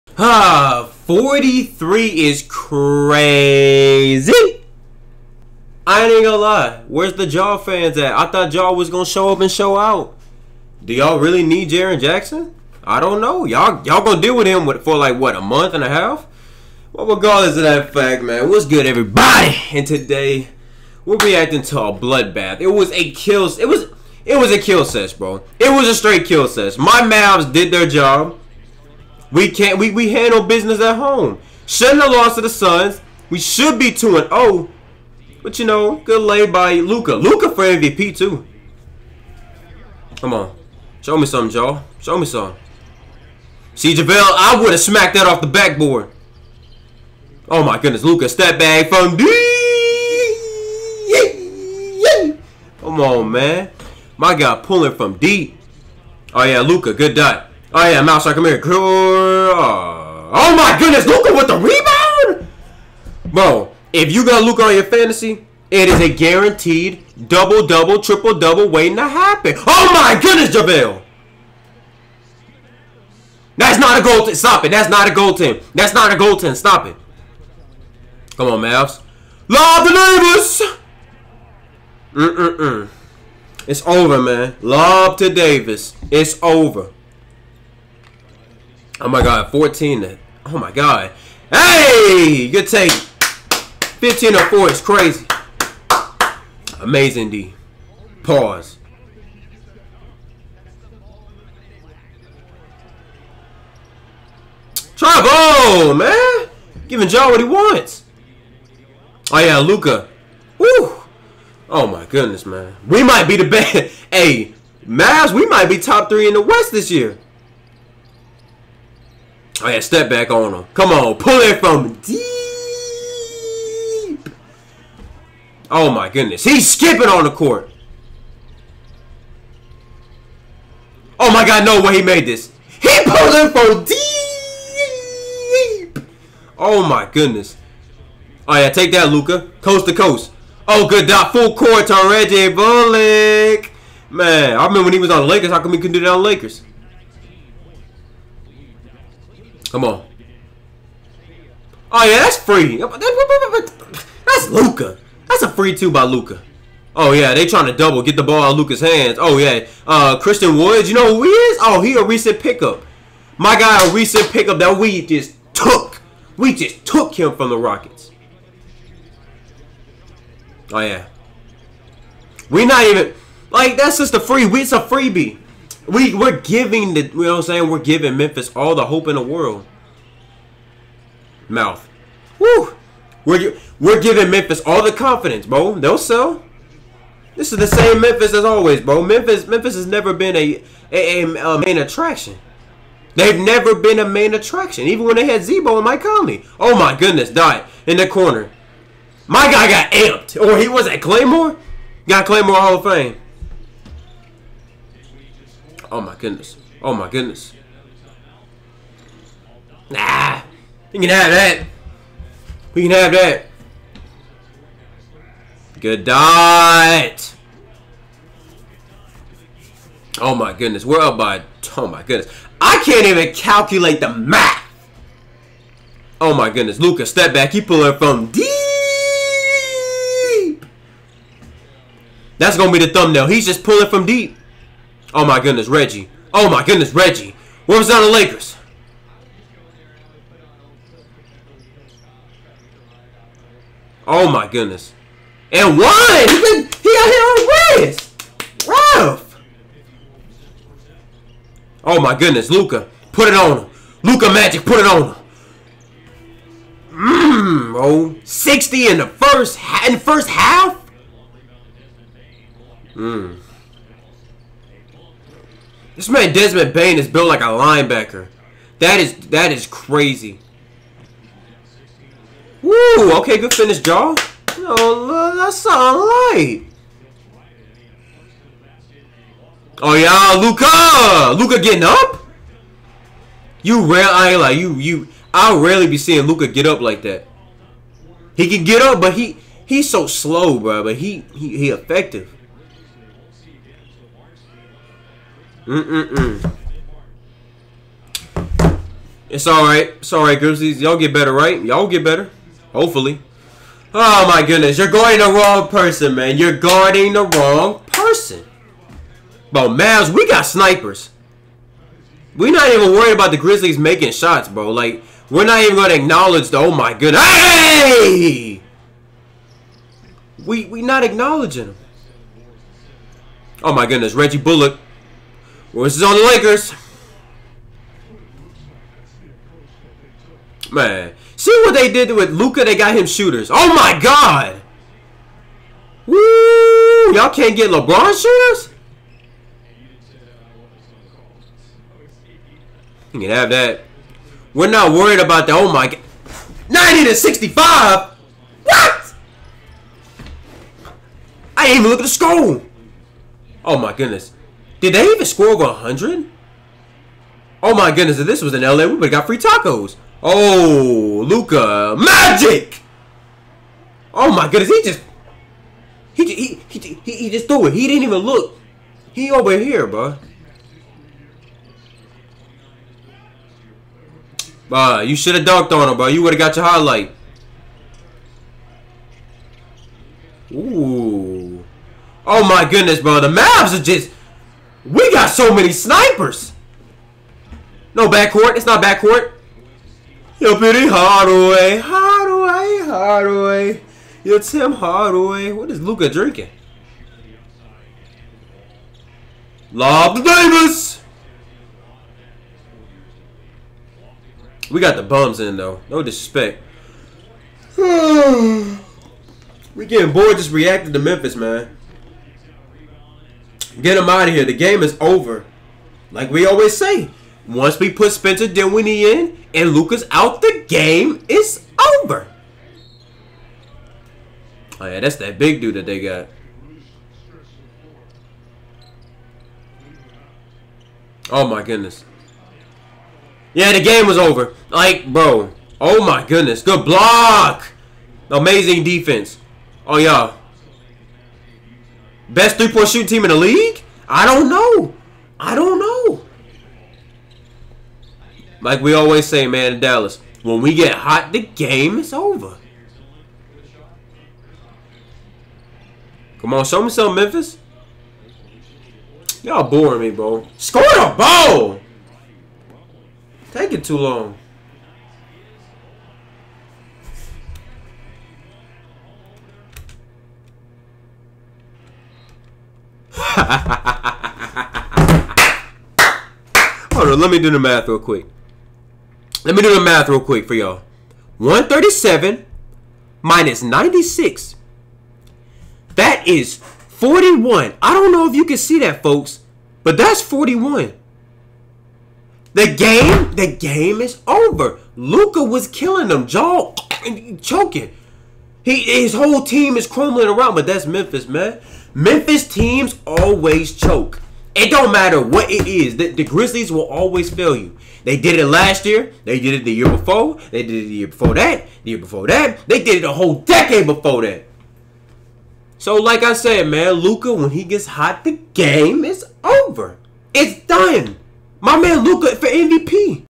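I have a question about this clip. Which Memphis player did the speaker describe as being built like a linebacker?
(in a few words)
Desmond Bane.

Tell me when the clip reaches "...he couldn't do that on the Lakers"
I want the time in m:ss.
2:25.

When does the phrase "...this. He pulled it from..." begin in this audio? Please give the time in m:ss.
2:12.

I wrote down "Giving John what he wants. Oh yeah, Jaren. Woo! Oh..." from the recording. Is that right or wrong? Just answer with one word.
wrong.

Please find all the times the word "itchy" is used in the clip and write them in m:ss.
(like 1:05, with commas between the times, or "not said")
not said.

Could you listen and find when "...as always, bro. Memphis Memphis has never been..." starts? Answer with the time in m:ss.
3:08.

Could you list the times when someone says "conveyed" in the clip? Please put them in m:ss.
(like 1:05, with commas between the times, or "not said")
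not said.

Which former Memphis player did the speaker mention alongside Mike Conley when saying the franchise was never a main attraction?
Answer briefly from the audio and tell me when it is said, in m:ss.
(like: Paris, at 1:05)
Z-Bo, at 3:15.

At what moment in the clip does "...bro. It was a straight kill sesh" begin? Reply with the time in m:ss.
0:25.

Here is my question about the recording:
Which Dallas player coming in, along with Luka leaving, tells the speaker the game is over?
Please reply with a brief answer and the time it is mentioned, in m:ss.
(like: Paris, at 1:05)
Spencer Dinwiddie, at 6:58.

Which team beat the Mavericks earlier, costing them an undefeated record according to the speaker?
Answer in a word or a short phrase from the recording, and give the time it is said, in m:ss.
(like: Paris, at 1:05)
Suns, at 0:32.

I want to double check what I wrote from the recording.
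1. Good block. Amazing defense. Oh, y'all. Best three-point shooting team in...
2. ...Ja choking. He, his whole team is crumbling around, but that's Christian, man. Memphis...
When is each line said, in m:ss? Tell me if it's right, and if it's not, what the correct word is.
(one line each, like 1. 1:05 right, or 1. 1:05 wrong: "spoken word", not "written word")
1. 7:16 right
2. 8:16 wrong: "Memphis", not "Christian".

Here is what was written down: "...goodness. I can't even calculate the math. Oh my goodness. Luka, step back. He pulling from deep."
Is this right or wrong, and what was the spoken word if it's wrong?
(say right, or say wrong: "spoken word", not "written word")
right.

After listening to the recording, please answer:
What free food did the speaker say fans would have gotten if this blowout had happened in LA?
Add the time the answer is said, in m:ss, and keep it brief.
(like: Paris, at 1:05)
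tacos, at 5:59.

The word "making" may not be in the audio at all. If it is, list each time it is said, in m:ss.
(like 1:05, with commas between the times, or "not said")
5:13.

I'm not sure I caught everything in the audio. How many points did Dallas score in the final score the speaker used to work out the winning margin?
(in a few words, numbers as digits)
137.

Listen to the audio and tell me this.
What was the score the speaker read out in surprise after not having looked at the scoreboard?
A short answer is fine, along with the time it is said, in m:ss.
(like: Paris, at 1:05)
90 to 65, at 5:46.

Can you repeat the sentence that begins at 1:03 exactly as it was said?
If you got Luka on your fantasy, it is a guaranteed double double, triple double waiting to happen.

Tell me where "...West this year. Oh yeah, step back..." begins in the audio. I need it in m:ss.
1:56.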